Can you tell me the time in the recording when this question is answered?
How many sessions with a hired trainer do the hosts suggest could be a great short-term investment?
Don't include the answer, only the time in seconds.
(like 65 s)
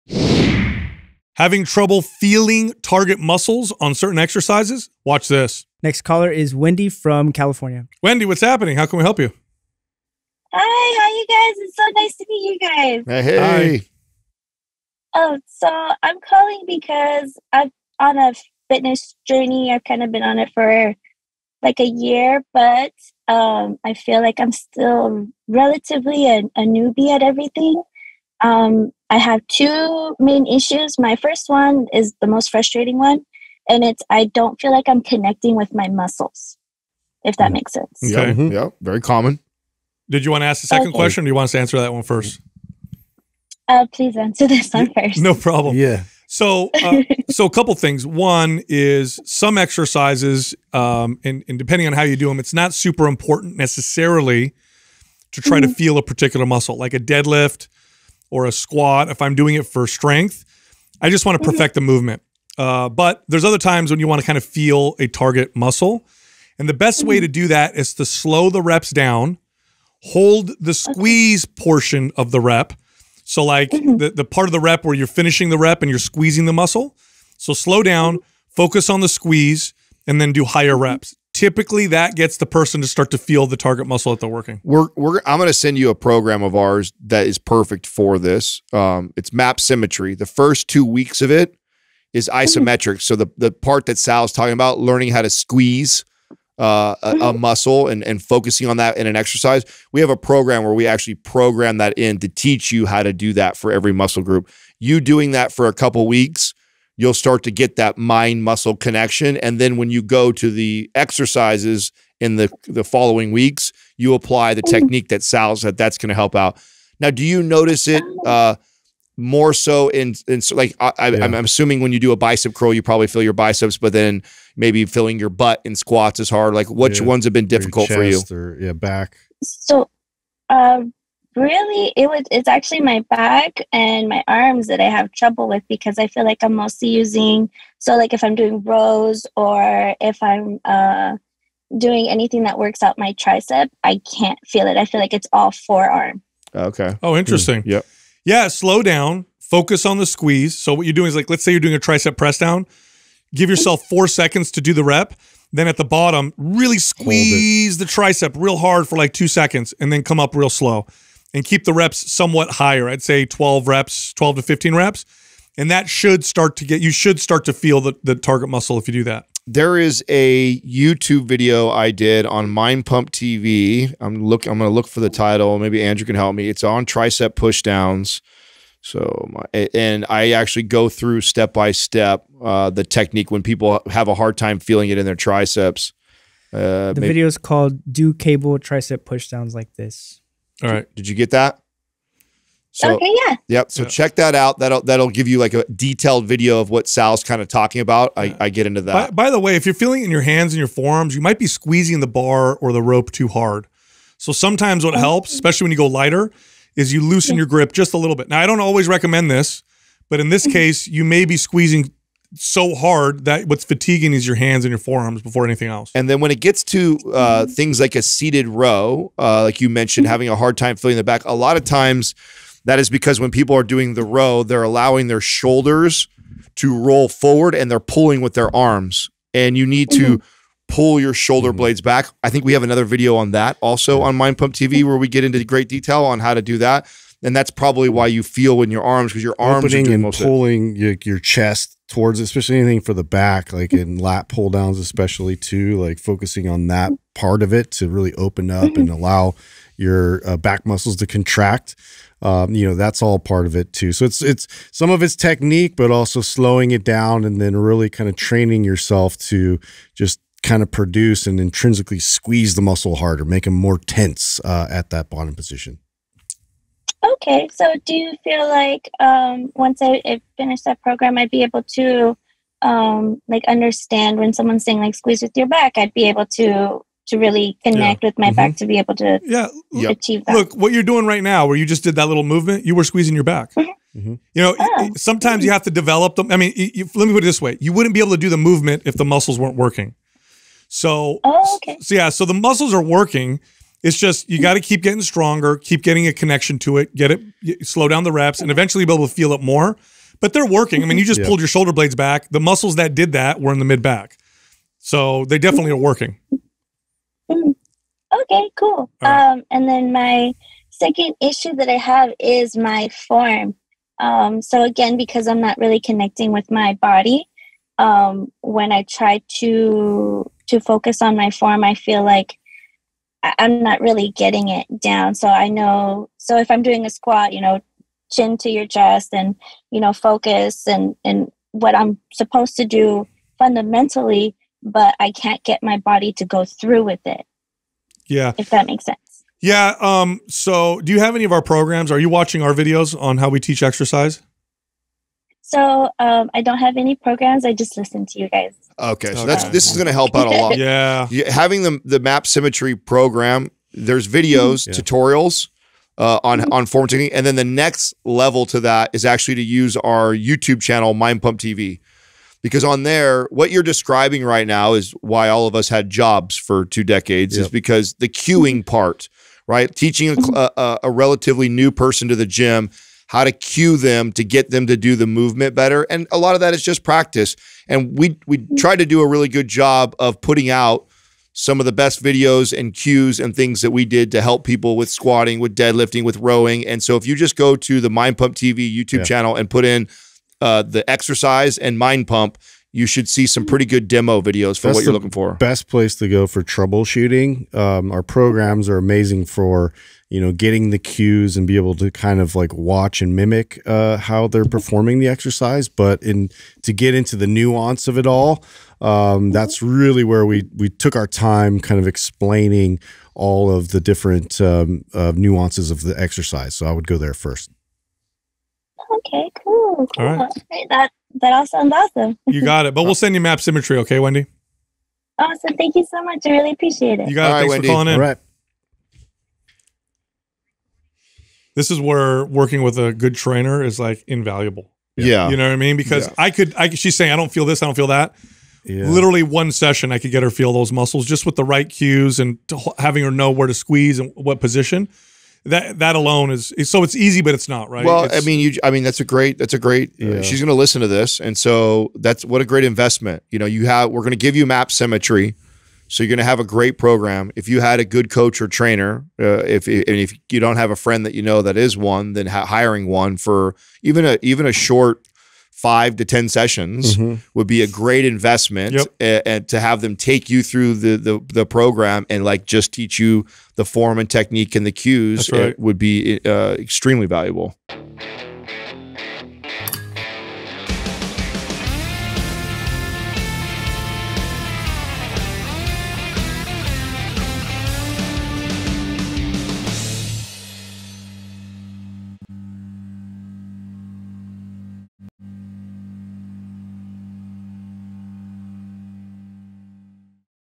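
465 s.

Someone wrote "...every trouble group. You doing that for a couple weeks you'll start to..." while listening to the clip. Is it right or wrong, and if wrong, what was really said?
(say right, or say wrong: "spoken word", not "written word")
wrong: "muscle", not "trouble".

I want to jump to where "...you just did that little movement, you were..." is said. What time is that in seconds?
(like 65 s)
281 s.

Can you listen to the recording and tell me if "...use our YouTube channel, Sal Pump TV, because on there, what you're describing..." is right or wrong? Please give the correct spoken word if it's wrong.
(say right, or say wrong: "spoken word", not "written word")
wrong: "Mind", not "Sal".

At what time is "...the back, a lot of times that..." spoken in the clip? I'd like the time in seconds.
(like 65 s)
220 s.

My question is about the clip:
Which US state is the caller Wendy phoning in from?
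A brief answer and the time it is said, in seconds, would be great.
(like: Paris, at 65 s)
California, at 7 s.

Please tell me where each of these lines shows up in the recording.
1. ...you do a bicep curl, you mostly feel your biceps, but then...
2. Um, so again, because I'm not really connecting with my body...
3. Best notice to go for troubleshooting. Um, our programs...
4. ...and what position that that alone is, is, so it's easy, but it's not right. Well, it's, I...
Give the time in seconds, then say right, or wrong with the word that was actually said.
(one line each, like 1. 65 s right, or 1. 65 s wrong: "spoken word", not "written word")
1. 121 s wrong: "probably", not "mostly"
2. 313 s right
3. 395 s wrong: "place", not "notice"
4. 443 s right.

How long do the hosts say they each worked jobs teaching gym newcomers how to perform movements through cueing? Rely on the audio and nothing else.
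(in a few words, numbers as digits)
two decades.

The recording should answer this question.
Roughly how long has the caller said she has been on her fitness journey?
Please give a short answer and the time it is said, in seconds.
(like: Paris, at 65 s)
a year, at 21 s.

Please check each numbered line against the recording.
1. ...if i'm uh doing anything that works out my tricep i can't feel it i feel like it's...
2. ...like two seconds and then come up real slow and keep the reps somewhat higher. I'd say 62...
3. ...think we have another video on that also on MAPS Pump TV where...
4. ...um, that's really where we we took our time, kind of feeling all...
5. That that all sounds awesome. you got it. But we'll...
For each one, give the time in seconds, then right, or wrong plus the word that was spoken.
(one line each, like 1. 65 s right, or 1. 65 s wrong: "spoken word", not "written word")
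1. 140 s right
2. 158 s wrong: "12", not "62"
3. 232 s wrong: "Mind", not "MAPS"
4. 408 s wrong: "explaining", not "feeling"
5. 420 s right.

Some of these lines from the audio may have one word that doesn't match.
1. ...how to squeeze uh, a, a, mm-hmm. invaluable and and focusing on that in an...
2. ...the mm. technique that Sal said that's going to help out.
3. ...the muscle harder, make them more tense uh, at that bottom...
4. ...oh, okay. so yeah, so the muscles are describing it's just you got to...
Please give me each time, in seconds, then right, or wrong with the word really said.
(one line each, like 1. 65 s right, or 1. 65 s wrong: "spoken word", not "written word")
1. 95 s wrong: "muscle", not "invaluable"
2. 114 s right
3. 262 s right
4. 291 s wrong: "working", not "describing".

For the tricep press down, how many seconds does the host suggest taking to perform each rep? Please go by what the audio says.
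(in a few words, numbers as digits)
4.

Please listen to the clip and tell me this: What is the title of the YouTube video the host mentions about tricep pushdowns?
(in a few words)
Do Cable Tricep Pushdowns Like This.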